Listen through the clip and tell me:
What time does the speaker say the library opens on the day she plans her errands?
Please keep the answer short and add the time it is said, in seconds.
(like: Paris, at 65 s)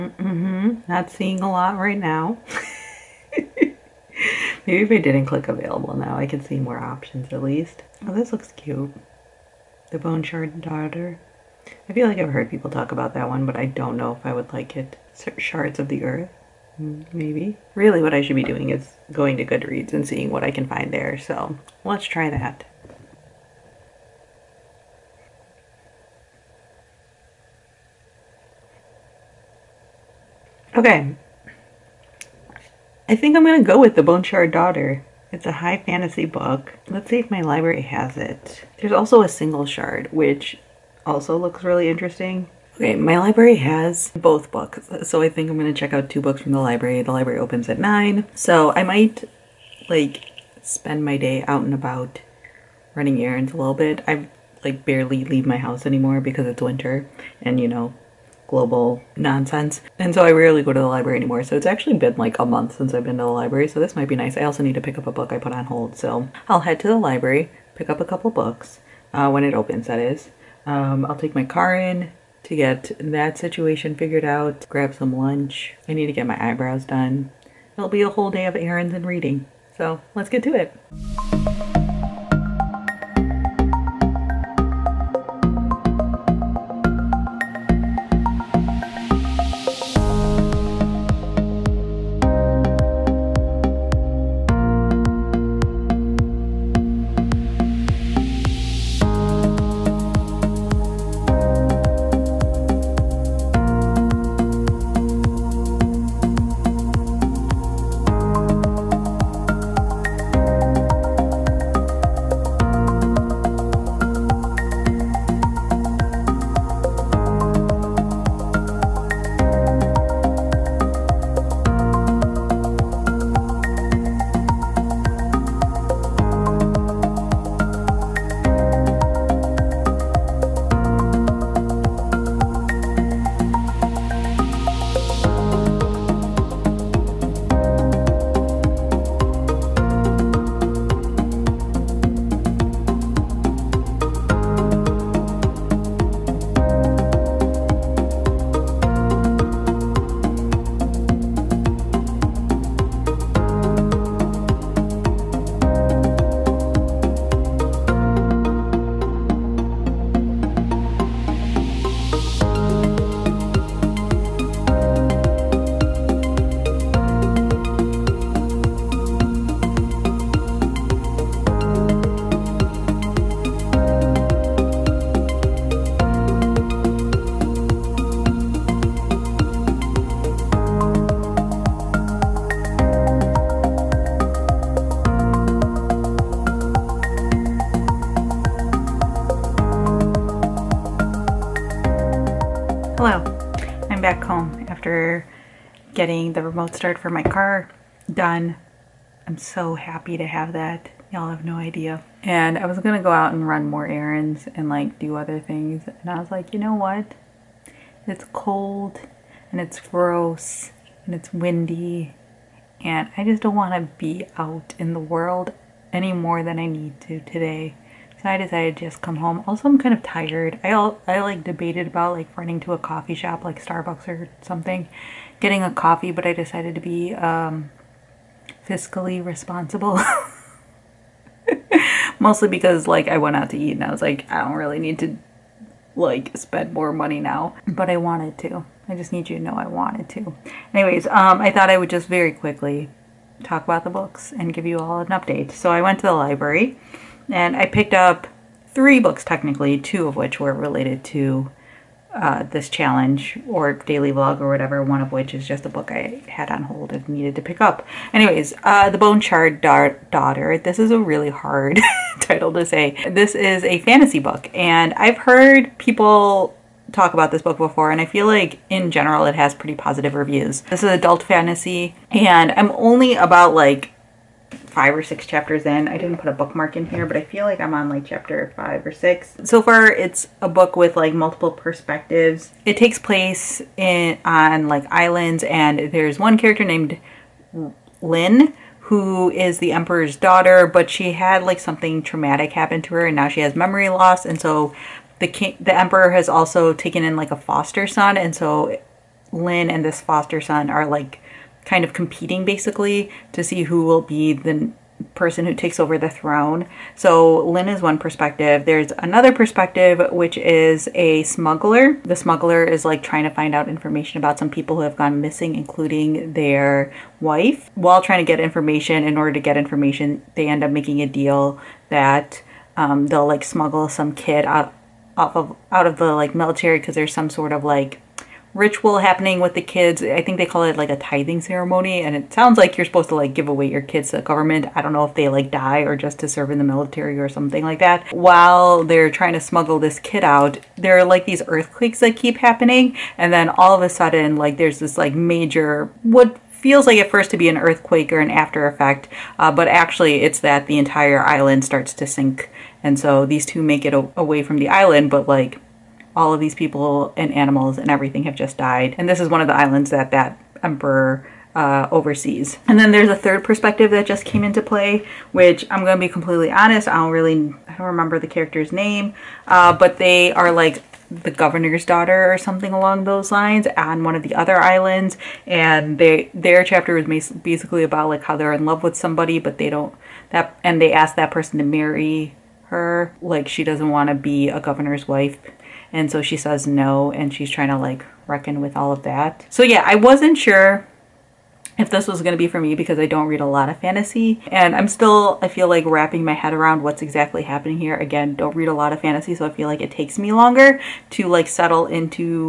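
9, at 47 s.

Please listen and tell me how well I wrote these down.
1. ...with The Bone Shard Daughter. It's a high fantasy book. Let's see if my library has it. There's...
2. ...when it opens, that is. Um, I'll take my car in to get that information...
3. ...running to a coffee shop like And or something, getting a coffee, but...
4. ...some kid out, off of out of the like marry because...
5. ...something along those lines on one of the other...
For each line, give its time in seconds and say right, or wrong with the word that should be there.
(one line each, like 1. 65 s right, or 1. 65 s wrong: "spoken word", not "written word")
1. 33 s right
2. 69 s wrong: "situation", not "information"
3. 222 s wrong: "Starbucks", not "And"
4. 323 s wrong: "military", not "marry"
5. 372 s right.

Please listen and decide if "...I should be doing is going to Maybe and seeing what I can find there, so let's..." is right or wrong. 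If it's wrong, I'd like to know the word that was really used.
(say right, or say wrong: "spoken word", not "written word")
wrong: "Goodreads", not "Maybe".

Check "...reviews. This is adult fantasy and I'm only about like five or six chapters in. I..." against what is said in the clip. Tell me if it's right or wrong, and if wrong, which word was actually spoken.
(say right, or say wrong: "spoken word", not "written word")
right.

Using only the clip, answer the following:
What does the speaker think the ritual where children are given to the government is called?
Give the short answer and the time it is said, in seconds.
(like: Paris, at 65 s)
tithing ceremony, at 330 s.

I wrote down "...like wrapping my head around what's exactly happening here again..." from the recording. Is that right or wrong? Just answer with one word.
right.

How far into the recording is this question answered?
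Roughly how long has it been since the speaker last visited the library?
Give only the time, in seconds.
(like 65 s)
62 s.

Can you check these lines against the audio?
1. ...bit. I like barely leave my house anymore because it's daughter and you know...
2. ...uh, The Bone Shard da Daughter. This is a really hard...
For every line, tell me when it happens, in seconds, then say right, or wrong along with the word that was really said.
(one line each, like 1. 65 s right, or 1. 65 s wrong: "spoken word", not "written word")
1. 53 s wrong: "winter", not "daughter"
2. 258 s right.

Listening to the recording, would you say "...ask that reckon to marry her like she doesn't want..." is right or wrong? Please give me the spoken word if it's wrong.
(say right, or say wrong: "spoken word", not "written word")
wrong: "person", not "reckon".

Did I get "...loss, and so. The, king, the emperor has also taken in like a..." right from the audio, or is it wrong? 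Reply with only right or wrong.
right.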